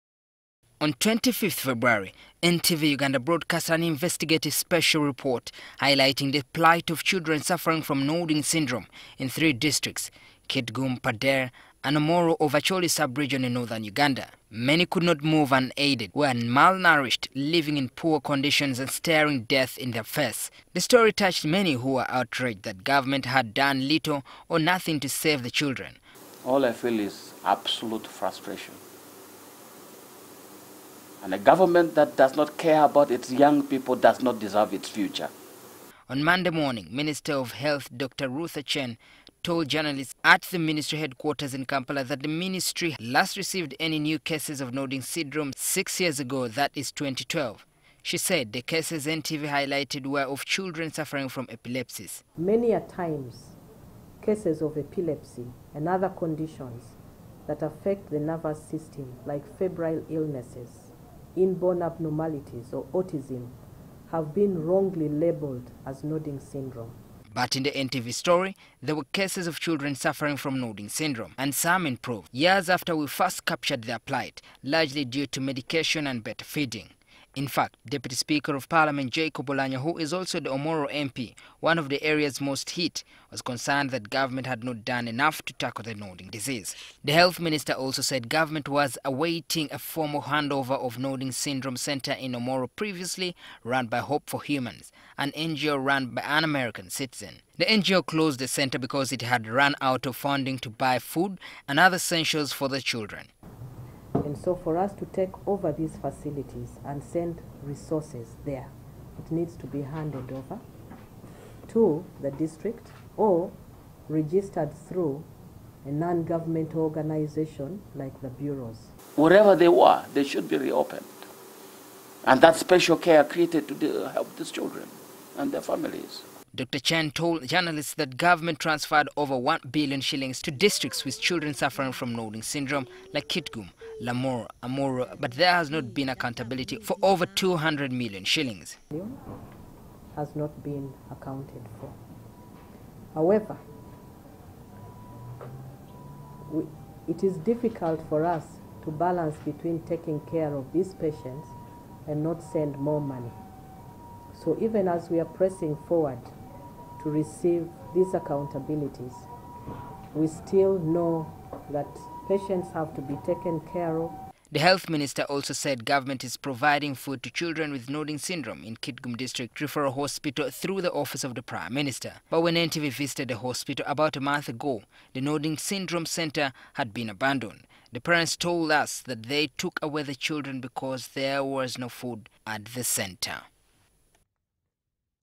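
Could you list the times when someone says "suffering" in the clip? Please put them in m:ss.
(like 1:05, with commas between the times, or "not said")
0:07, 0:50, 1:09, 2:11.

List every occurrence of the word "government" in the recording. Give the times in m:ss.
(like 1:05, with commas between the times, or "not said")
0:22, 0:31, 1:24, 1:28, 1:55, 2:08, 2:45.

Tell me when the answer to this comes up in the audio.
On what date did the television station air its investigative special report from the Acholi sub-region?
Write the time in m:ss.
0:00.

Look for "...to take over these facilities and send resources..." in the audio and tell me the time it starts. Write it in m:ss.
1:44.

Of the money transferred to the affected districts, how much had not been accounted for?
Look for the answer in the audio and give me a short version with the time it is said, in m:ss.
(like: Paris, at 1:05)
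200 million shillings, at 2:17.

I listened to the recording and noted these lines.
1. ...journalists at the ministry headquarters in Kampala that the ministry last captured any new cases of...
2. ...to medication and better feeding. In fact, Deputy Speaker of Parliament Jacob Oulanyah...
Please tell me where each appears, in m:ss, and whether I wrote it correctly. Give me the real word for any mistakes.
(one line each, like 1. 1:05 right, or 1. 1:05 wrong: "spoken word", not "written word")
1. 0:39 wrong: "received", not "captured"
2. 1:15 right.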